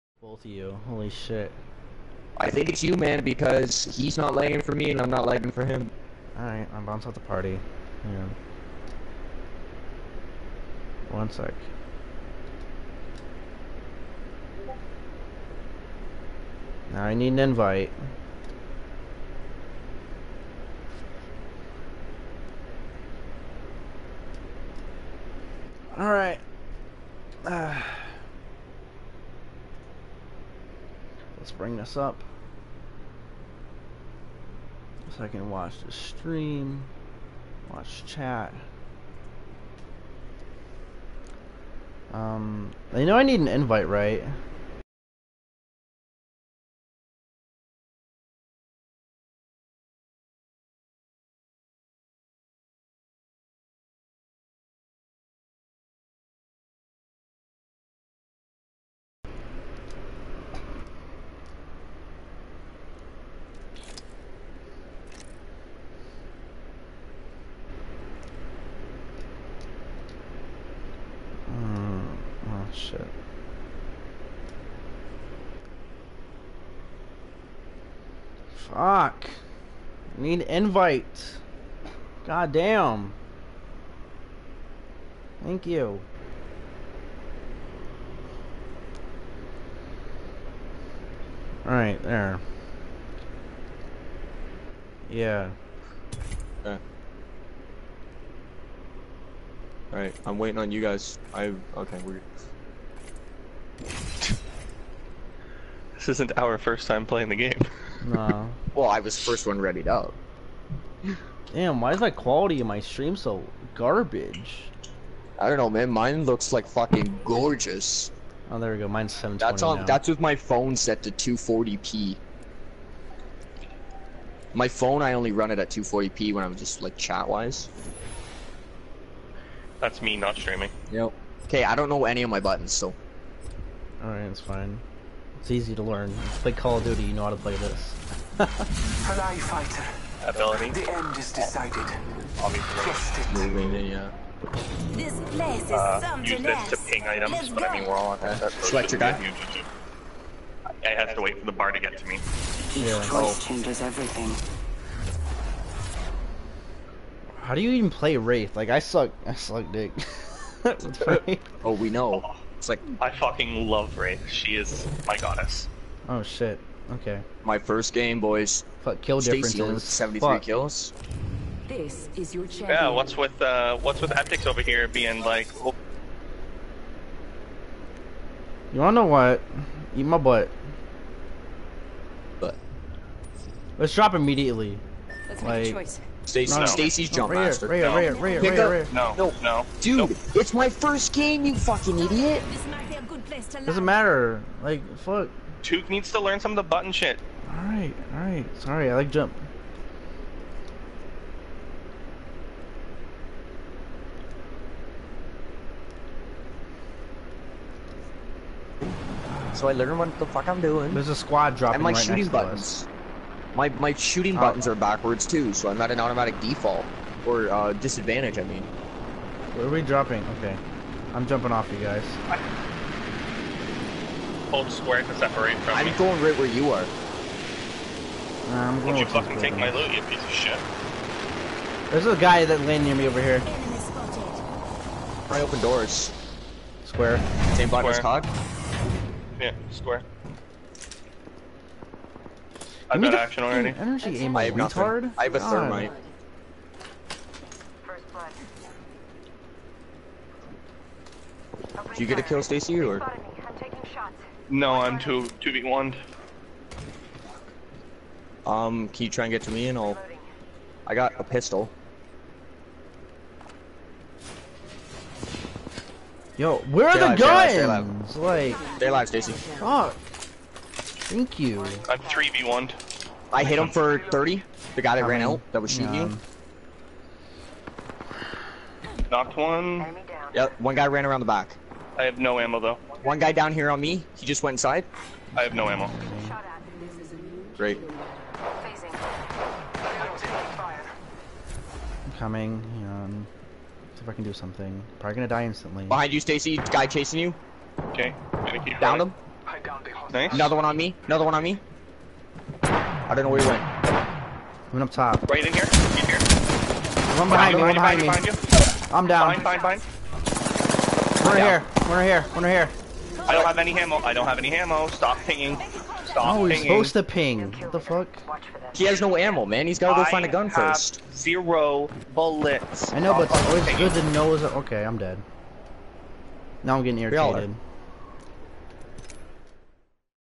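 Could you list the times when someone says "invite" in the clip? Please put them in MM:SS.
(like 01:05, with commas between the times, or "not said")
00:17, 00:43, 01:20.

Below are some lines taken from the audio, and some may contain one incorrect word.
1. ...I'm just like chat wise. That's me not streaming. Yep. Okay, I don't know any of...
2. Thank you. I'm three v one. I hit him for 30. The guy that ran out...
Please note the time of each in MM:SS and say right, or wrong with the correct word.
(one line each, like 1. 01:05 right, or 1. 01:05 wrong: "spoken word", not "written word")
1. 02:06 right
2. 04:31 right.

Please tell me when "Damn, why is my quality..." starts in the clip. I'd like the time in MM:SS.
01:51.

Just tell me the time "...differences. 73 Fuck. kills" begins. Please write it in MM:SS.
02:49.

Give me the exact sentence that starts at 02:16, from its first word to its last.
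play Call of Duty, you know how to play this.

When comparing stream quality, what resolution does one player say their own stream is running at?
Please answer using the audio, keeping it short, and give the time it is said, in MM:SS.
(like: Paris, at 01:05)
720, at 01:58.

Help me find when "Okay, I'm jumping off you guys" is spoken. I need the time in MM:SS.
03:40.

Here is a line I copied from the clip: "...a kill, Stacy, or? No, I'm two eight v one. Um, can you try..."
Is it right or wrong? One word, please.
wrong.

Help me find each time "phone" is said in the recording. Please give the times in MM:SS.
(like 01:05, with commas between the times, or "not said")
02:00, 02:04.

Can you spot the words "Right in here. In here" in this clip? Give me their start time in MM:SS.
05:05.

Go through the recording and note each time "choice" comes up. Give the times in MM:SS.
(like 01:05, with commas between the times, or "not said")
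02:33, 03:05.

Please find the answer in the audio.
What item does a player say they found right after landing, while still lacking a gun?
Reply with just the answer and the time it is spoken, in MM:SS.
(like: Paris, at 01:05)
Thermite, at 04:05.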